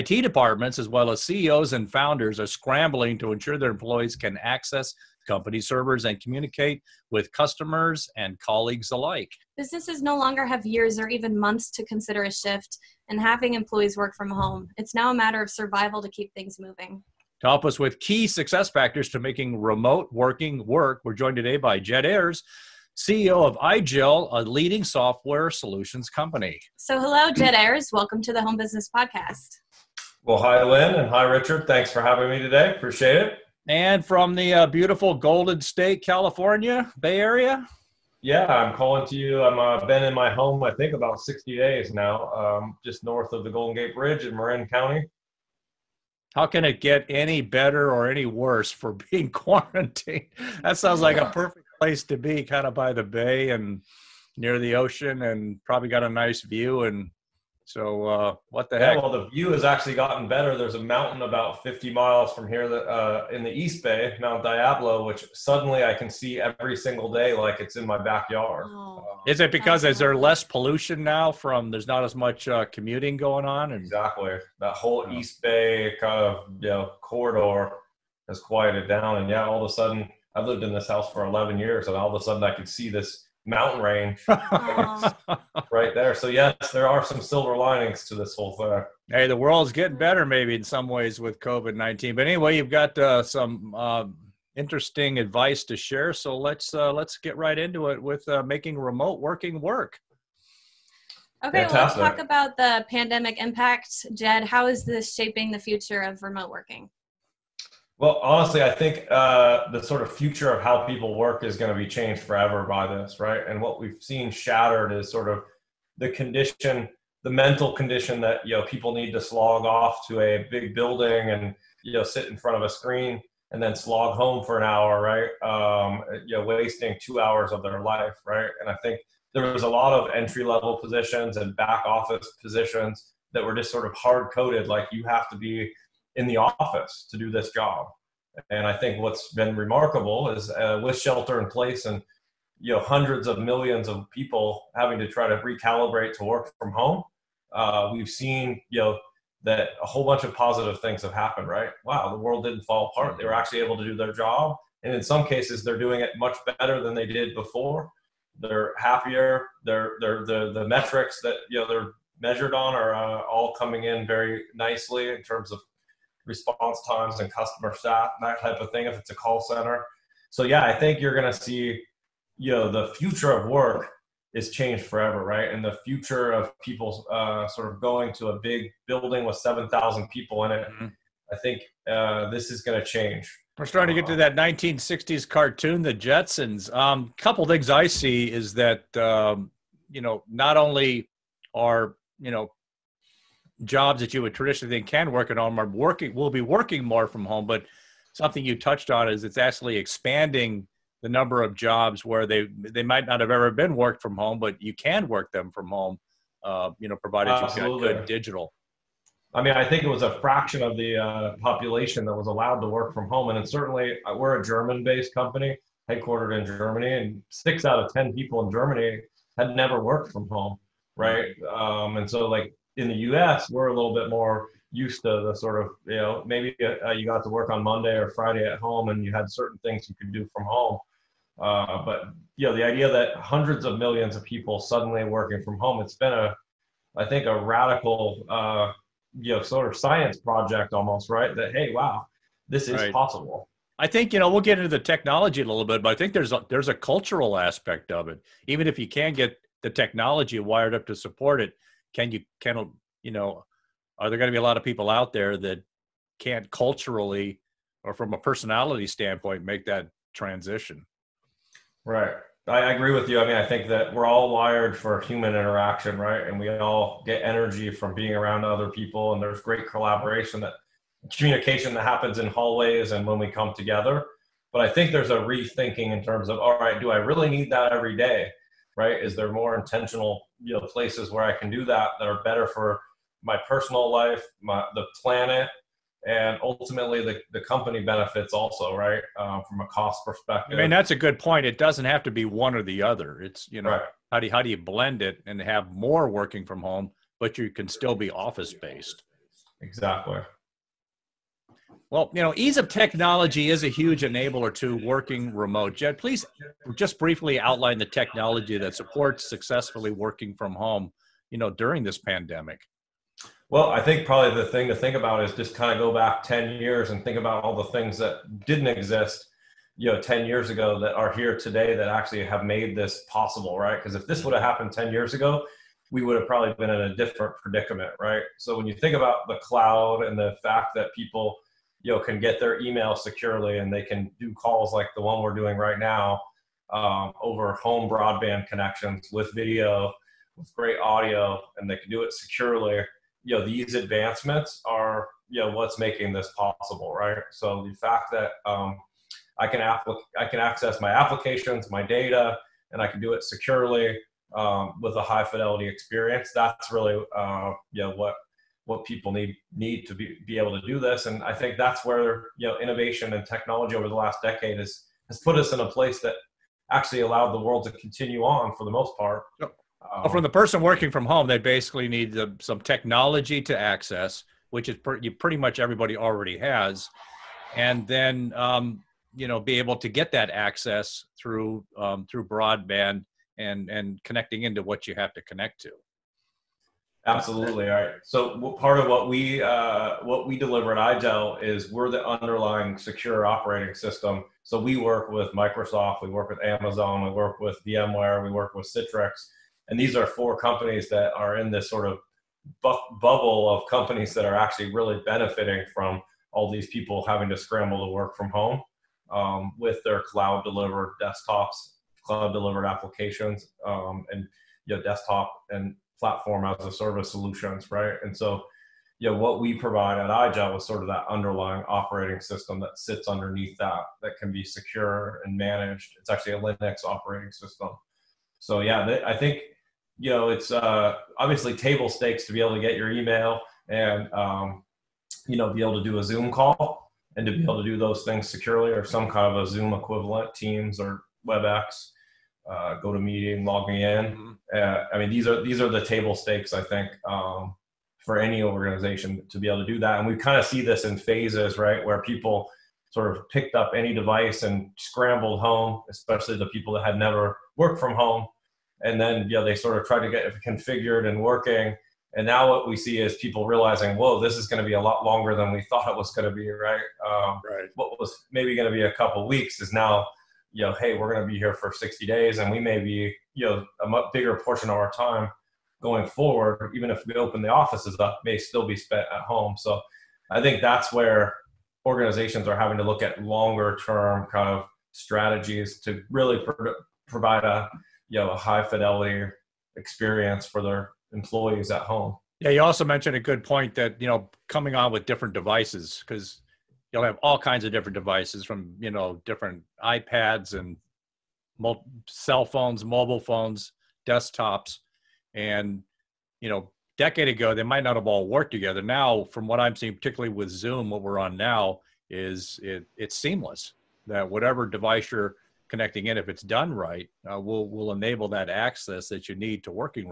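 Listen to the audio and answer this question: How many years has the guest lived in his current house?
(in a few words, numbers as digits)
11.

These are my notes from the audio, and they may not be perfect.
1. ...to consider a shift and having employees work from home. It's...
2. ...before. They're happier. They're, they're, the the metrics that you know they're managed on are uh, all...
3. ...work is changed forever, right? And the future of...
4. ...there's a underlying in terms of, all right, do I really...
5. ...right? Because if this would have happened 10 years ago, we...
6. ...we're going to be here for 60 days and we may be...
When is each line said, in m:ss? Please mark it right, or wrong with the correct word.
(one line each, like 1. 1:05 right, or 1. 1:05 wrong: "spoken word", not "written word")
1. 0:11 right
2. 2:37 wrong: "measured", not "managed"
3. 2:53 right
4. 4:34 wrong: "rethinking", not "underlying"
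5. 5:23 right
6. 7:50 right.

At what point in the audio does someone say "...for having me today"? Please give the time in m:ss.
0:31.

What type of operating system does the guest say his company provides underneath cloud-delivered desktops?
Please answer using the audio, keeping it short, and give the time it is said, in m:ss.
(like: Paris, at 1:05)
Linux, at 7:06.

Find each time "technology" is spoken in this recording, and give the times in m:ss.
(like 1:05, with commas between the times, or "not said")
4:04, 4:09, 5:02, 5:07, 6:03, 6:12.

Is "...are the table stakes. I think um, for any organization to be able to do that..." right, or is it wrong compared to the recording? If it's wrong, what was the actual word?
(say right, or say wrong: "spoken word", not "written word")
right.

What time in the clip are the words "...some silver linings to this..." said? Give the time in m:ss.
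1:27.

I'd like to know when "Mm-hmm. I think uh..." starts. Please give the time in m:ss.
3:00.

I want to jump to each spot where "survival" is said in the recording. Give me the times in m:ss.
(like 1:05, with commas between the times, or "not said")
0:15.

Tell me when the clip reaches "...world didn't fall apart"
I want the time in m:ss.
2:32.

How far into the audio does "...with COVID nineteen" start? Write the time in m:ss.
1:31.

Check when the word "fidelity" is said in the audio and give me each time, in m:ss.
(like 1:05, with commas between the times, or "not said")
5:55, 8:08.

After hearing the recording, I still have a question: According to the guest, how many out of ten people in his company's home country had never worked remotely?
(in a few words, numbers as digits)
6.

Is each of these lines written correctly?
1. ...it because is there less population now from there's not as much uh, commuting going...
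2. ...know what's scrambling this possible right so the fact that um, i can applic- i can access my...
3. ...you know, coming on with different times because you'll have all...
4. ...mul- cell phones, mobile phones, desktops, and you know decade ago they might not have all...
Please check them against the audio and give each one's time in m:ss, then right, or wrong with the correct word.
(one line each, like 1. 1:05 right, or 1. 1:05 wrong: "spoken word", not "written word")
1. 1:09 wrong: "pollution", not "population"
2. 5:45 wrong: "making", not "scrambling"
3. 8:14 wrong: "devices", not "times"
4. 8:21 right.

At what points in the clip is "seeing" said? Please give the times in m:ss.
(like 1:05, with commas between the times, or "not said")
8:29.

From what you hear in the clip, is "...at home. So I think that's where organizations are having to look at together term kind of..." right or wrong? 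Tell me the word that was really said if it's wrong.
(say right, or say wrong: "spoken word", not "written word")
wrong: "longer", not "together".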